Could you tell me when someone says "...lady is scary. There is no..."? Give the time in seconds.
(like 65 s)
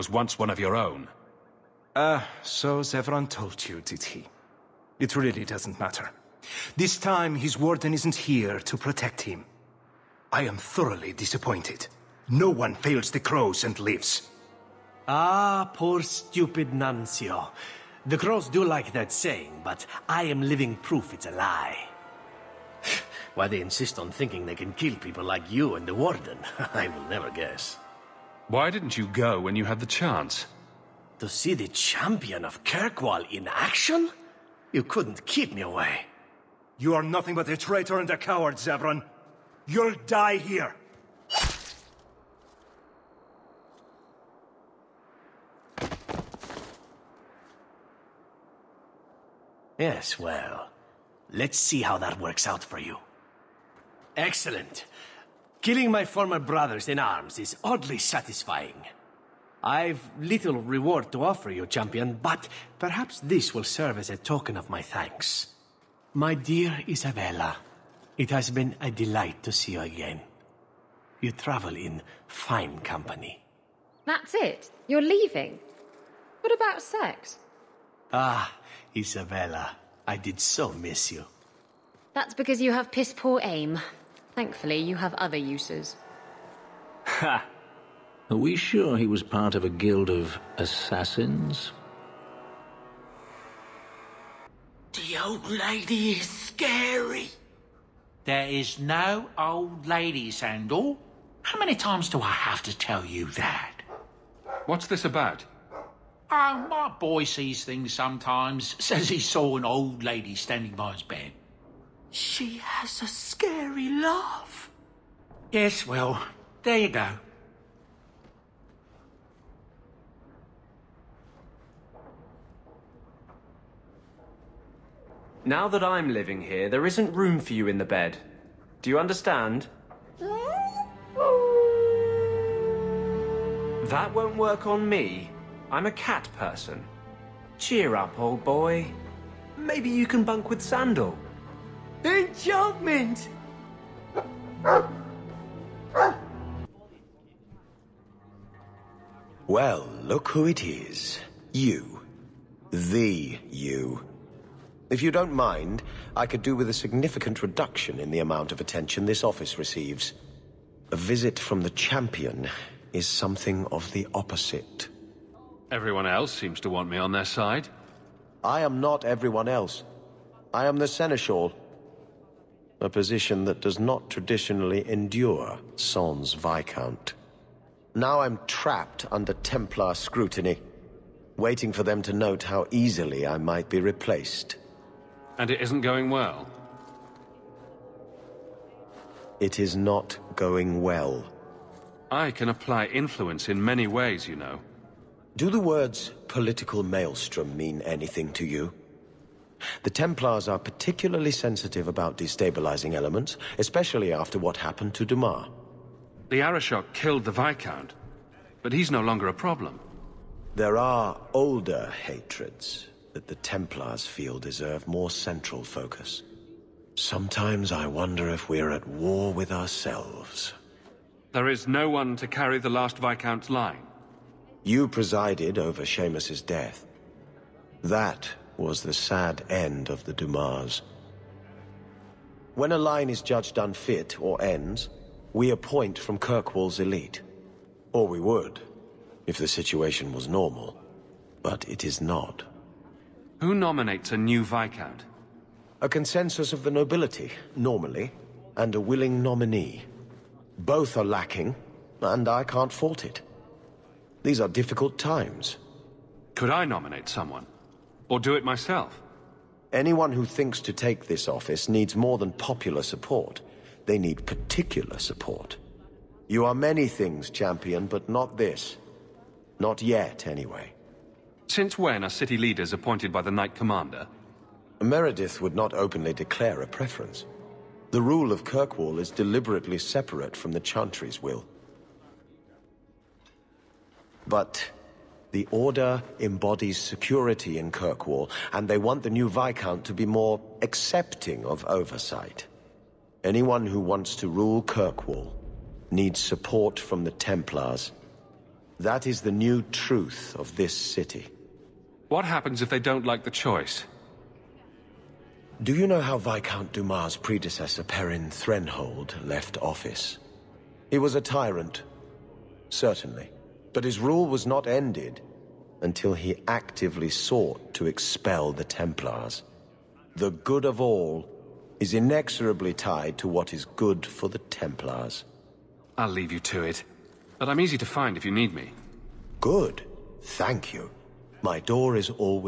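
95 s.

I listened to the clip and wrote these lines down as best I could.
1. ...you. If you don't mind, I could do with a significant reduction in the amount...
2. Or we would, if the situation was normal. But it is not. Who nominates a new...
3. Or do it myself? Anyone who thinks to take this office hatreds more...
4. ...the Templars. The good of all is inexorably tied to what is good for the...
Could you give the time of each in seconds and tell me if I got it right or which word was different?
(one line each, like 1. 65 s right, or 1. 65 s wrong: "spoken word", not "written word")
1. 153 s right
2. 237 s right
3. 258 s wrong: "needs", not "hatreds"
4. 318 s right.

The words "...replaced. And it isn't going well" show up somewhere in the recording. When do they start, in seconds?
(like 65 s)
183 s.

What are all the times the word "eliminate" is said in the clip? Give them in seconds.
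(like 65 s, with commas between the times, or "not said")
not said.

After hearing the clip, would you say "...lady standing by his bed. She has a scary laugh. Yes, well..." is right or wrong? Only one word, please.
right.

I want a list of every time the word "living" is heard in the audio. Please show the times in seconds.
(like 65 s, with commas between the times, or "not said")
20 s, 126 s.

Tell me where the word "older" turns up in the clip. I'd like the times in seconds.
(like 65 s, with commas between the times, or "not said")
211 s.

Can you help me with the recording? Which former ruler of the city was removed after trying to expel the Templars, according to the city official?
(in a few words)
Perrin Threnhold.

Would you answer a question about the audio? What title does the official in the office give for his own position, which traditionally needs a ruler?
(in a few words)
Seneschal.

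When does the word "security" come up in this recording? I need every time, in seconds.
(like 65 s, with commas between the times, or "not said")
286 s.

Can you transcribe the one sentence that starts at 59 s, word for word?
I've little reward to offer you, champion, but perhaps this will serve as a token of my thanks.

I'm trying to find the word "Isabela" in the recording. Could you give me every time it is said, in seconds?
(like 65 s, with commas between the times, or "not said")
66 s, 78 s.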